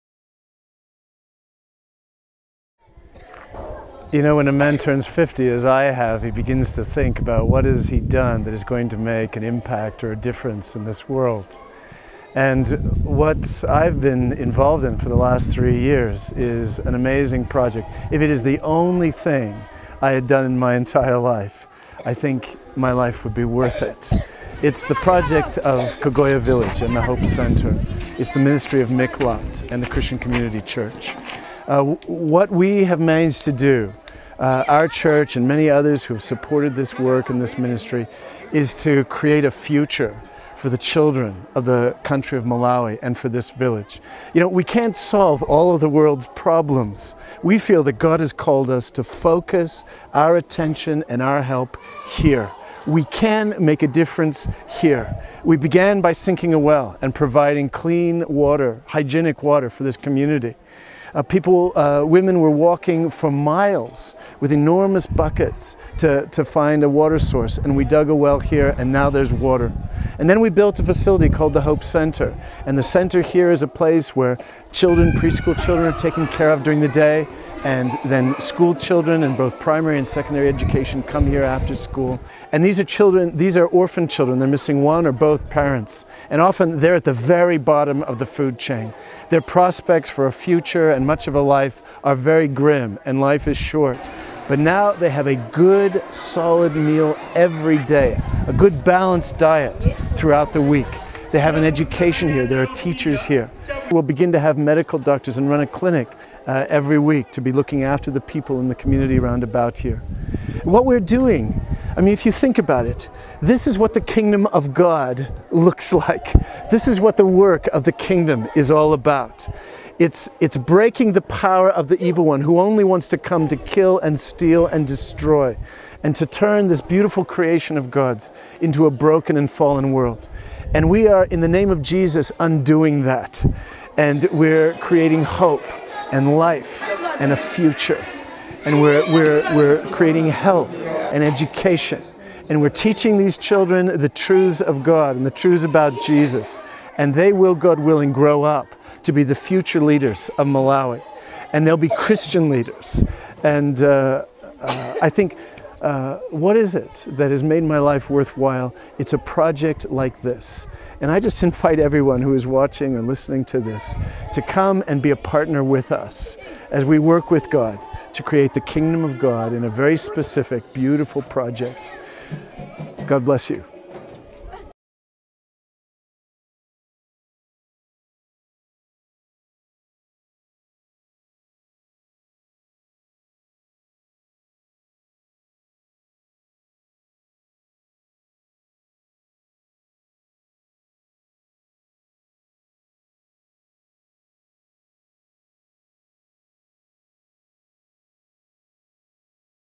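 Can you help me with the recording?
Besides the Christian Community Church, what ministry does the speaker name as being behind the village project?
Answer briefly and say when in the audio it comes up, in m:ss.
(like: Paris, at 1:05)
Miqlat, at 0:28.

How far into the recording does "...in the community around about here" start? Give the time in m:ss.
1:48.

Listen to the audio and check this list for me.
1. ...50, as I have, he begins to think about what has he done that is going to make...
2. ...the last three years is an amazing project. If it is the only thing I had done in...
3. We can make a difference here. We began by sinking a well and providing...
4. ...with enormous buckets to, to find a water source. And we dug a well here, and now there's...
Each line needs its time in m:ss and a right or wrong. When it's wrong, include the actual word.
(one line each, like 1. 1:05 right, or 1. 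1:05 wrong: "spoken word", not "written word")
1. 0:05 right
2. 0:15 right
3. 0:52 right
4. 1:04 right.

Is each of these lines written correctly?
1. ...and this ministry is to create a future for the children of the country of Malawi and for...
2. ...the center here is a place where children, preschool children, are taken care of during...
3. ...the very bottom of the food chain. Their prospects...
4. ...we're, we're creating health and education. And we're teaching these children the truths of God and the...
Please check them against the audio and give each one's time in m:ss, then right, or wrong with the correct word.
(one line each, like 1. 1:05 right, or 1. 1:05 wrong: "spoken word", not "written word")
1. 0:37 right
2. 1:12 right
3. 1:27 right
4. 2:19 right.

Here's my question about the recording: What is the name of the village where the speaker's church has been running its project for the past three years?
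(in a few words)
Kogoya Village.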